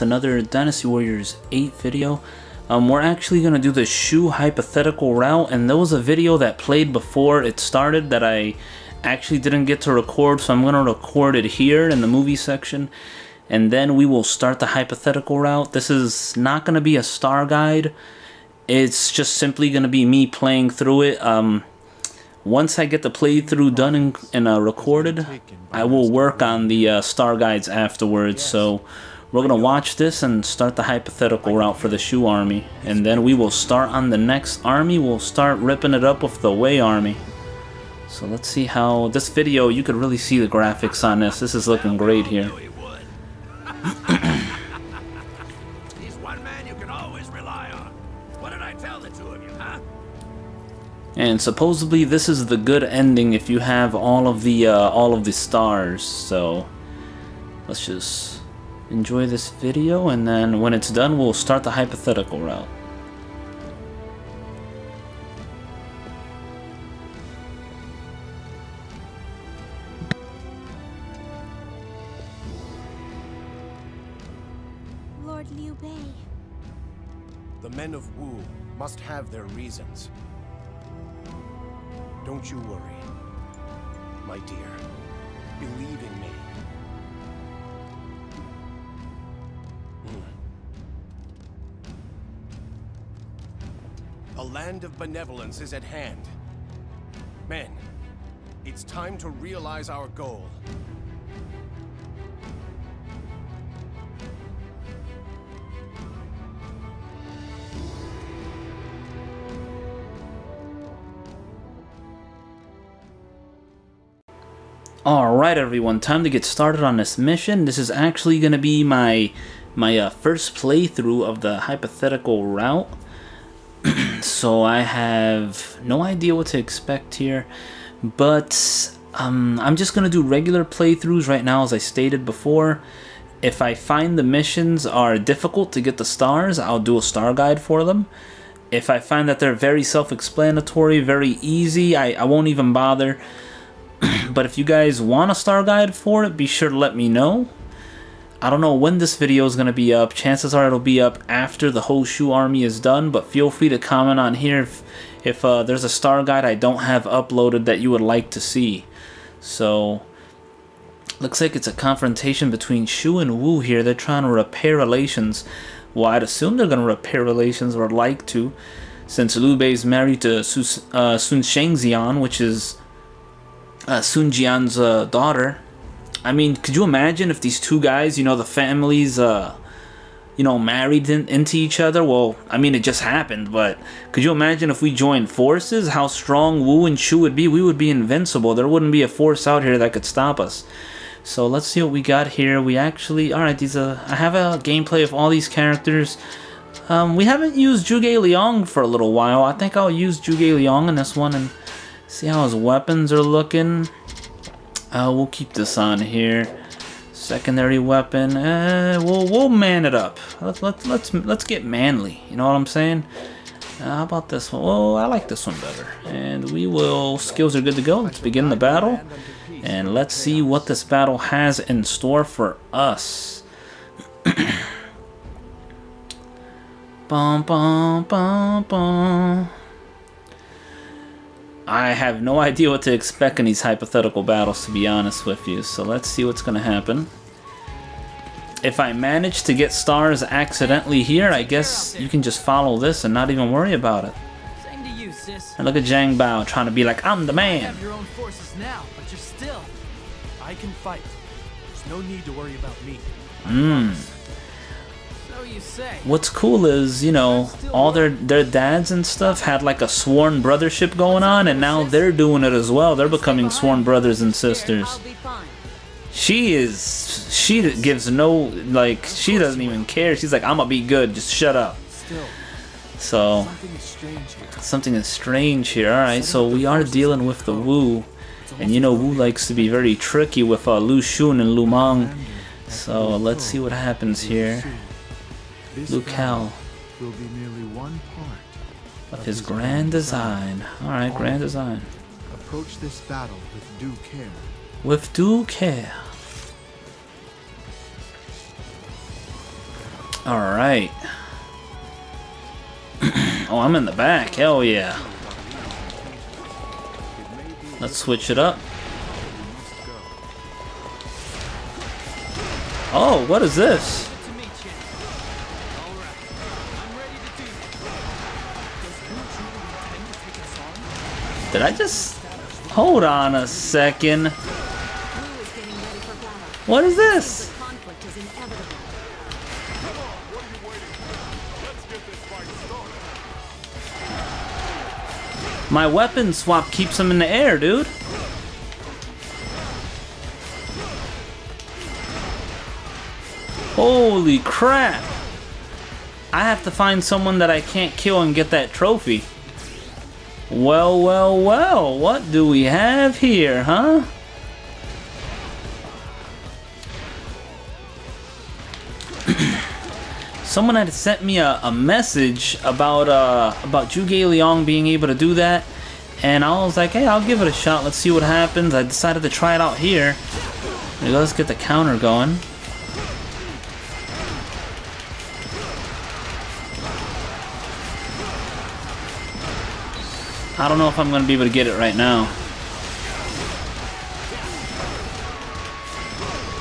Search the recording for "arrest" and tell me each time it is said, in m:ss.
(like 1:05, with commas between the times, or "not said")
not said.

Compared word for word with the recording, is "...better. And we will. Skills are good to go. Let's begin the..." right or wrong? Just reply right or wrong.
right.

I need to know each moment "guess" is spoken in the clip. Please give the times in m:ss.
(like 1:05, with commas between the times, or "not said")
4:01.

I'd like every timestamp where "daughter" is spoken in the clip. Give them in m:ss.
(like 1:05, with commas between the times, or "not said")
2:55.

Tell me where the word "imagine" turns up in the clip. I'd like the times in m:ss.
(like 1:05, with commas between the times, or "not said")
2:56, 3:04.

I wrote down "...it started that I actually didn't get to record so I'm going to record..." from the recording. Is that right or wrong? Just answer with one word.
right.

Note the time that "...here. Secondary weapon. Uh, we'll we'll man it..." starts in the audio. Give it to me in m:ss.
3:26.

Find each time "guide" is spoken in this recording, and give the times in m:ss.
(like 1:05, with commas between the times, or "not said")
0:17, 0:27, 2:17, 2:25, 2:36.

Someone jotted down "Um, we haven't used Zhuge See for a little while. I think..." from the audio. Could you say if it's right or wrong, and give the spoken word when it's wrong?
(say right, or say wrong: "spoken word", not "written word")
wrong: "Liang", not "See".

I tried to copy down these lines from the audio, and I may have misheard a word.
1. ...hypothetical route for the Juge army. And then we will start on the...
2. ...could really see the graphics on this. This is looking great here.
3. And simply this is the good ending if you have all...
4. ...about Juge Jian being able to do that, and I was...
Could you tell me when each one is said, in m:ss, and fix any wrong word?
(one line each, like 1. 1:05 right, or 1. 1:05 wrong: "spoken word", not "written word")
1. 0:30 wrong: "Shu", not "Juge"
2. 0:39 right
3. 0:51 wrong: "supposedly", not "simply"
4. 6:03 wrong: "Leong", not "Jian".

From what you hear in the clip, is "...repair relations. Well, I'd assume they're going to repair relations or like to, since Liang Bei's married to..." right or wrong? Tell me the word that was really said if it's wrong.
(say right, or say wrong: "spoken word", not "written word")
wrong: "Liu", not "Liang".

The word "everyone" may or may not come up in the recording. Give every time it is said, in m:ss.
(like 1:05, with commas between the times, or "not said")
1:55.